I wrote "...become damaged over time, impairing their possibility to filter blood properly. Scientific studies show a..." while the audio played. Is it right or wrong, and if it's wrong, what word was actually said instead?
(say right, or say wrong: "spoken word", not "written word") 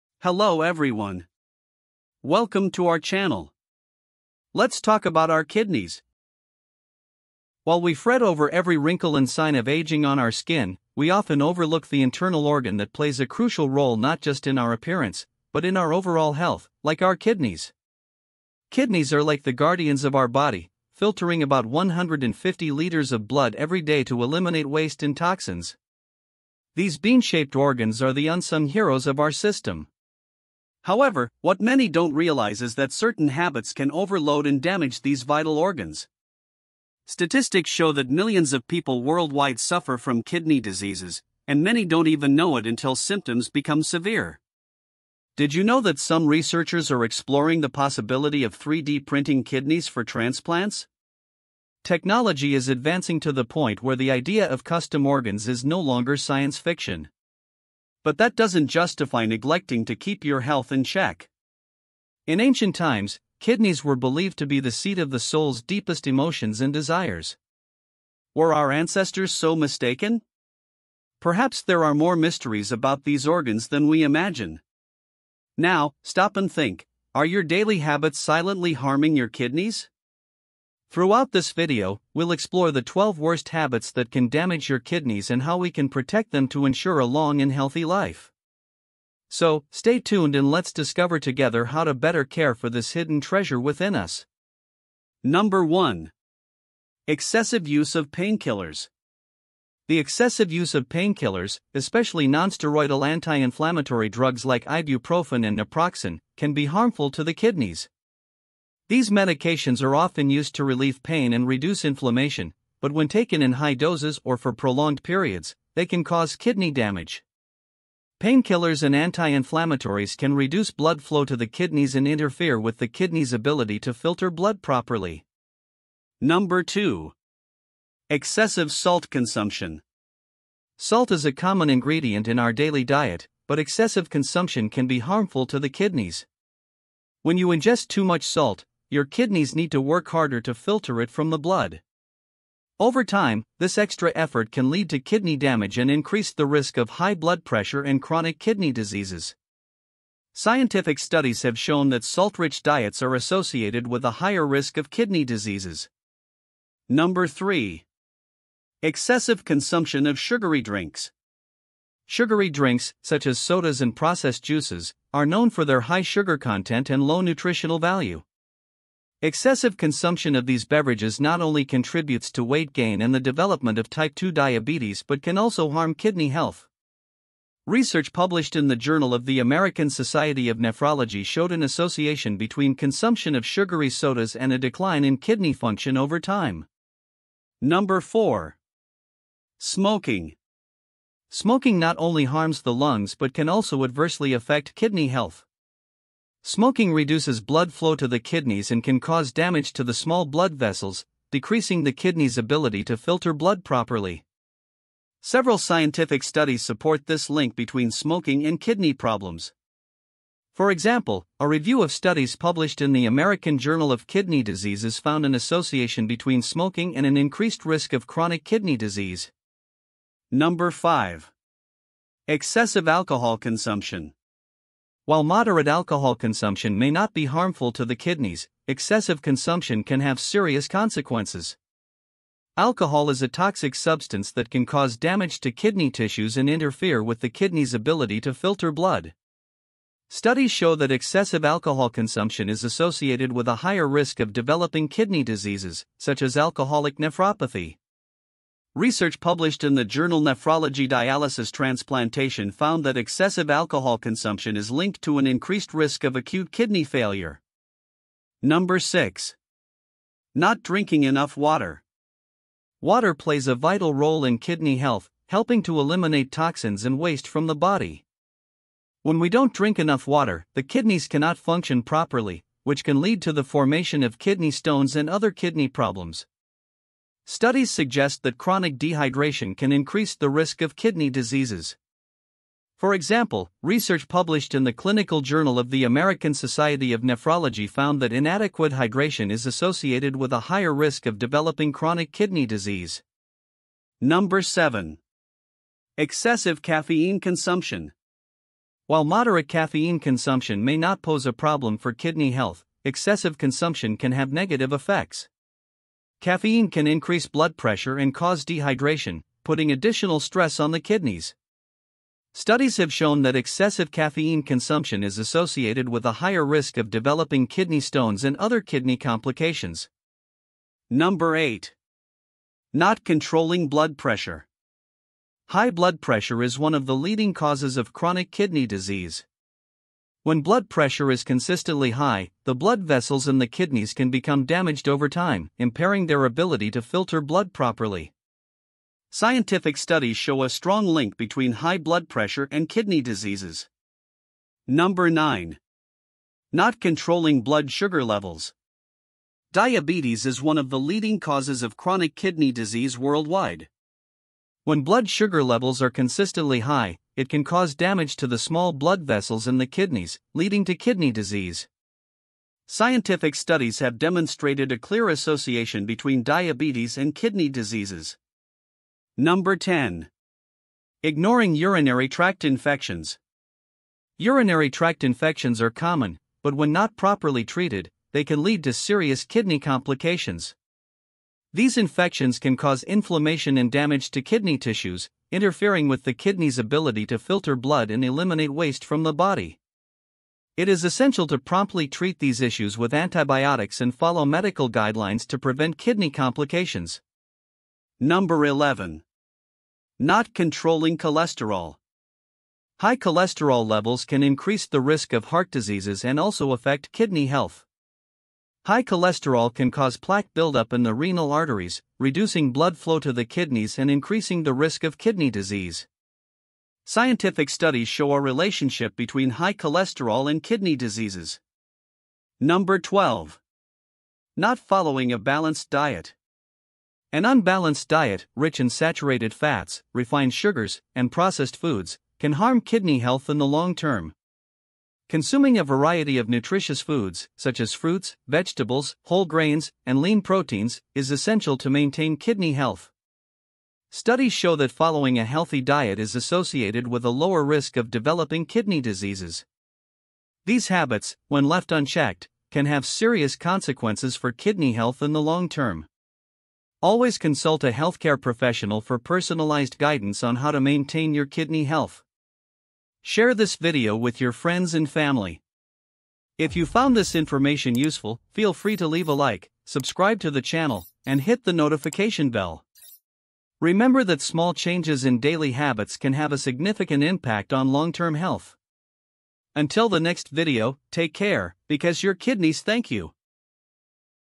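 wrong: "ability", not "possibility".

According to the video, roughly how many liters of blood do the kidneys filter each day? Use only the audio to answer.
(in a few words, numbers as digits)
150 liters.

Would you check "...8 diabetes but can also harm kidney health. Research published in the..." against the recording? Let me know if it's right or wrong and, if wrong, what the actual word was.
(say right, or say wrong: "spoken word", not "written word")
wrong: "2", not "8".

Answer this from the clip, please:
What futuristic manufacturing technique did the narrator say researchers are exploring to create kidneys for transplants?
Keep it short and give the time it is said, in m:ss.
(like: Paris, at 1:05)
3D printing, at 0:48.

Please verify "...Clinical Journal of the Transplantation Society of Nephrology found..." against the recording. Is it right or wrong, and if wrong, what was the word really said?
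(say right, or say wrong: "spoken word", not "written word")
wrong: "American", not "Transplantation".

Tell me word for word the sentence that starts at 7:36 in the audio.
Always consult a healthcare professional for personalized guidance on how to maintain your kidney health.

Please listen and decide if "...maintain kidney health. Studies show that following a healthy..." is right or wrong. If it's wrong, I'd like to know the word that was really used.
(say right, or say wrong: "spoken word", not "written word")
right.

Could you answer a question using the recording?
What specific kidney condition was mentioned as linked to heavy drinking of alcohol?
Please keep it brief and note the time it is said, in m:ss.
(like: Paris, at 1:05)
alcoholic nephropathy, at 4:06.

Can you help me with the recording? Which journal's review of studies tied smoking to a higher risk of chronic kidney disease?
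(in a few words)
American Journal of Kidney Diseases.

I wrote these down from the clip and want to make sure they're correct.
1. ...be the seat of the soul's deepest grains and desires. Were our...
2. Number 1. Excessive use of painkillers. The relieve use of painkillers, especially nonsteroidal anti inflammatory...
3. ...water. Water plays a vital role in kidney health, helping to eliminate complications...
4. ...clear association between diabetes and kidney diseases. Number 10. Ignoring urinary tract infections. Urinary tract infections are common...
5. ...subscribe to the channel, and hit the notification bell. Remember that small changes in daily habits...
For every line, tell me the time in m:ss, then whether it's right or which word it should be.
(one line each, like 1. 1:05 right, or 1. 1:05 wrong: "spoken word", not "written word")
1. 1:04 wrong: "emotions", not "grains"
2. 1:35 wrong: "excessive", not "relieve"
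3. 4:21 wrong: "toxins", not "complications"
4. 6:04 right
5. 7:49 right.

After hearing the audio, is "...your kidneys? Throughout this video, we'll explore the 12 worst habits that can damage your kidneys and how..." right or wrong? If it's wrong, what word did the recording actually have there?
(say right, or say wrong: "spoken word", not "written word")
right.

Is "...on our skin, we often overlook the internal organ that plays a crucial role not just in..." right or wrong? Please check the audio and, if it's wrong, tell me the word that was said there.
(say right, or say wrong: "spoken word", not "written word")
right.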